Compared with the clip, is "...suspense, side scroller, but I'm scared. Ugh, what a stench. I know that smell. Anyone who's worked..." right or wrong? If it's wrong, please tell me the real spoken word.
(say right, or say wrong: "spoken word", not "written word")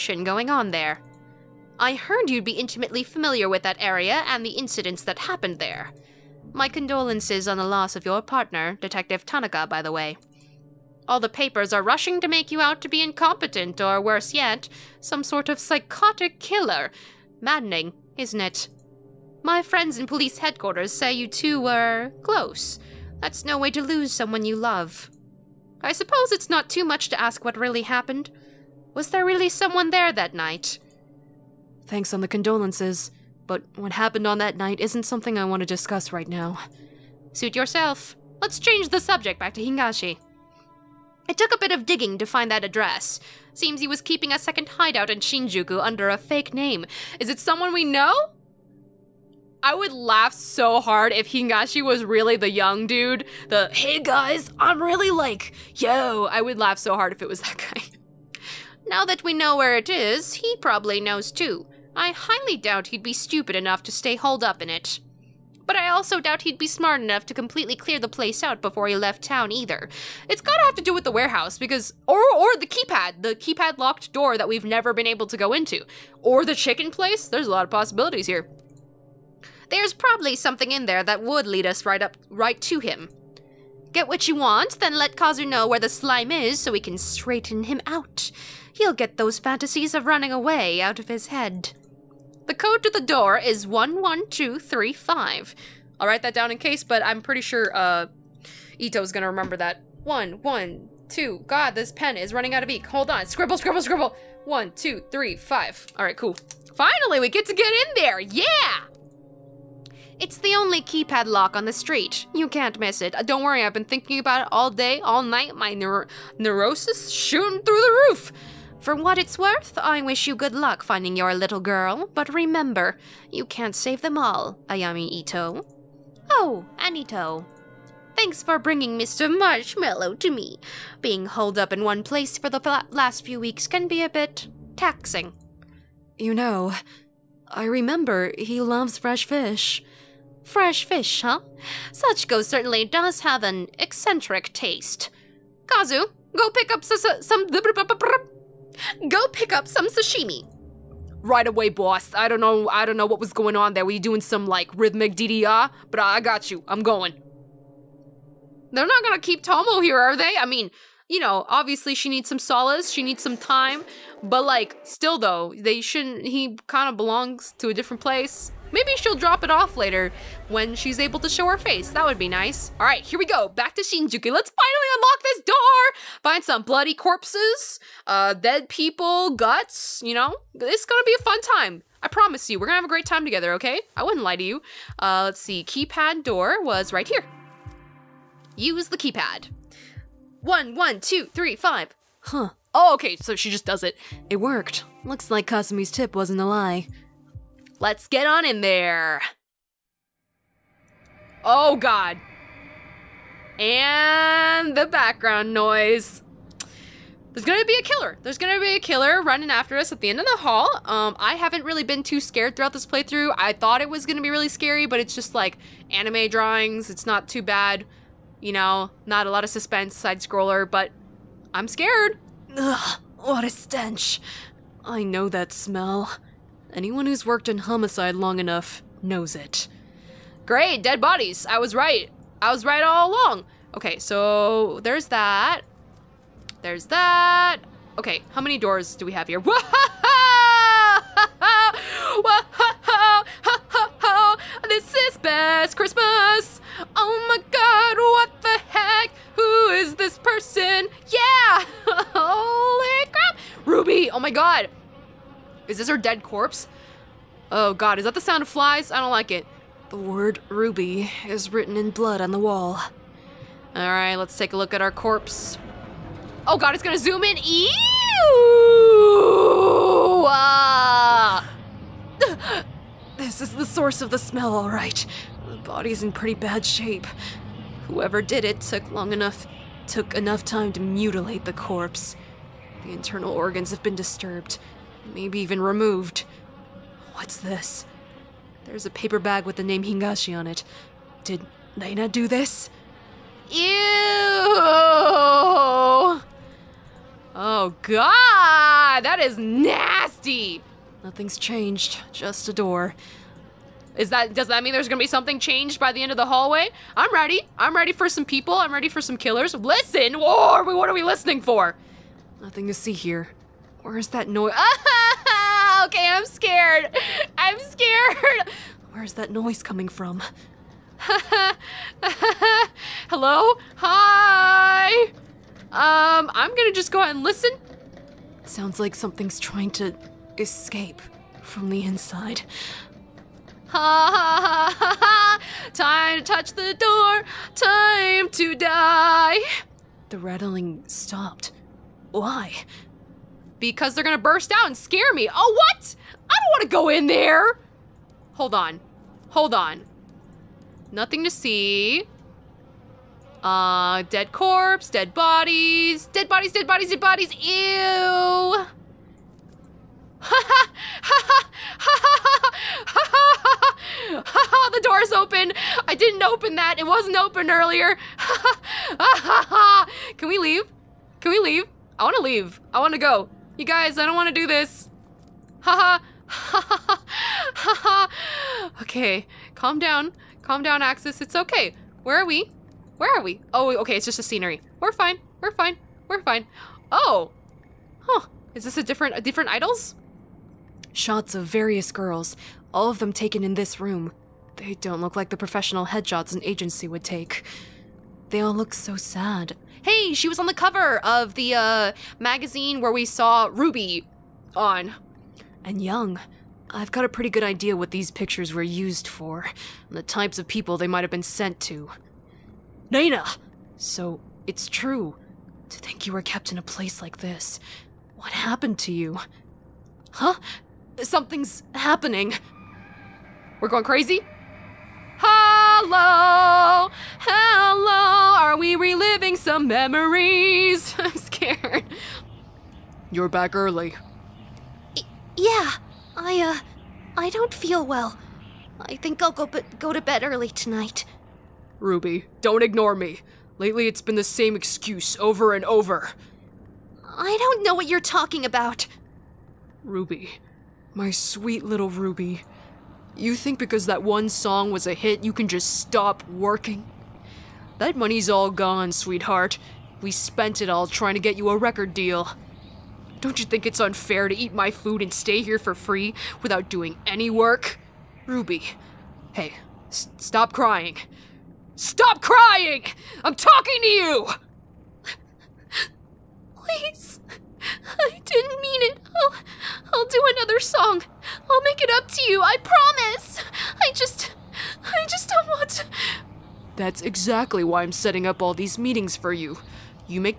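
right.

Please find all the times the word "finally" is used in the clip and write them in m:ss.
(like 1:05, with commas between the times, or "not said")
1:46, 2:54.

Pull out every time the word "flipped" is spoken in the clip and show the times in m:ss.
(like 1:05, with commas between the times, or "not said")
not said.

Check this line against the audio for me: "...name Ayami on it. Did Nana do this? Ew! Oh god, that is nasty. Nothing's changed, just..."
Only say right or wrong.
wrong.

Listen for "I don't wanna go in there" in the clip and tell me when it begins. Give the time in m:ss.
5:46.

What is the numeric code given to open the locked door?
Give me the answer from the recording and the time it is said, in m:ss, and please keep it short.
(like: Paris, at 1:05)
11235, at 1:33.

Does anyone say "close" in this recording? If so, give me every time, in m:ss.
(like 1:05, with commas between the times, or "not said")
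0:22.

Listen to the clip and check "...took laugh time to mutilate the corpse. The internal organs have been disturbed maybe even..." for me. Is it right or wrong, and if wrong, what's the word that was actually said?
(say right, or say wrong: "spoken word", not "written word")
wrong: "enough", not "laugh".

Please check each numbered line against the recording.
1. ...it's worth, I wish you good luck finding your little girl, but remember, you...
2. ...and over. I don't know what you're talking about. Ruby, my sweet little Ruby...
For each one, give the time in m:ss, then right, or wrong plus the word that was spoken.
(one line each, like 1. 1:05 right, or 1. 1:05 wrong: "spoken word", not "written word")
1. 1:59 right
2. 7:25 right.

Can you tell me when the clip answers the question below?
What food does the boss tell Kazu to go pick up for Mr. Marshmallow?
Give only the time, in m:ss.
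2:29.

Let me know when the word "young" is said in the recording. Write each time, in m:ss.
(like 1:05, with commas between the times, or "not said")
0:52, 6:45.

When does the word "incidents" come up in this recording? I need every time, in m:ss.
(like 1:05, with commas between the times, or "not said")
0:04.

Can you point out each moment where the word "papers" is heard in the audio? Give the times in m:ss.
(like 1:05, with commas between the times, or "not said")
0:11, 4:48.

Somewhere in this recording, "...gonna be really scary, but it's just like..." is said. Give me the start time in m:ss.
3:34.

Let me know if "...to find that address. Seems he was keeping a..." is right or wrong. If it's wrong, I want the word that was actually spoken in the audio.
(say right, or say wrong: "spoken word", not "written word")
right.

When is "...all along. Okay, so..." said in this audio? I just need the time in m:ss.
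3:52.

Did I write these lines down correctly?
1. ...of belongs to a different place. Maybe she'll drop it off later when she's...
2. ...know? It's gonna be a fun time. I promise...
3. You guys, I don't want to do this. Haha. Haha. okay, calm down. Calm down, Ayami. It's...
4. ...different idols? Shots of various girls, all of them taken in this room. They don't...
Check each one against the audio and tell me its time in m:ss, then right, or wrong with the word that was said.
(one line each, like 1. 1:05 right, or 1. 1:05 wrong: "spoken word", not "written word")
1. 2:46 right
2. 3:00 right
3. 6:13 wrong: "Axus", not "Ayami"
4. 6:29 right.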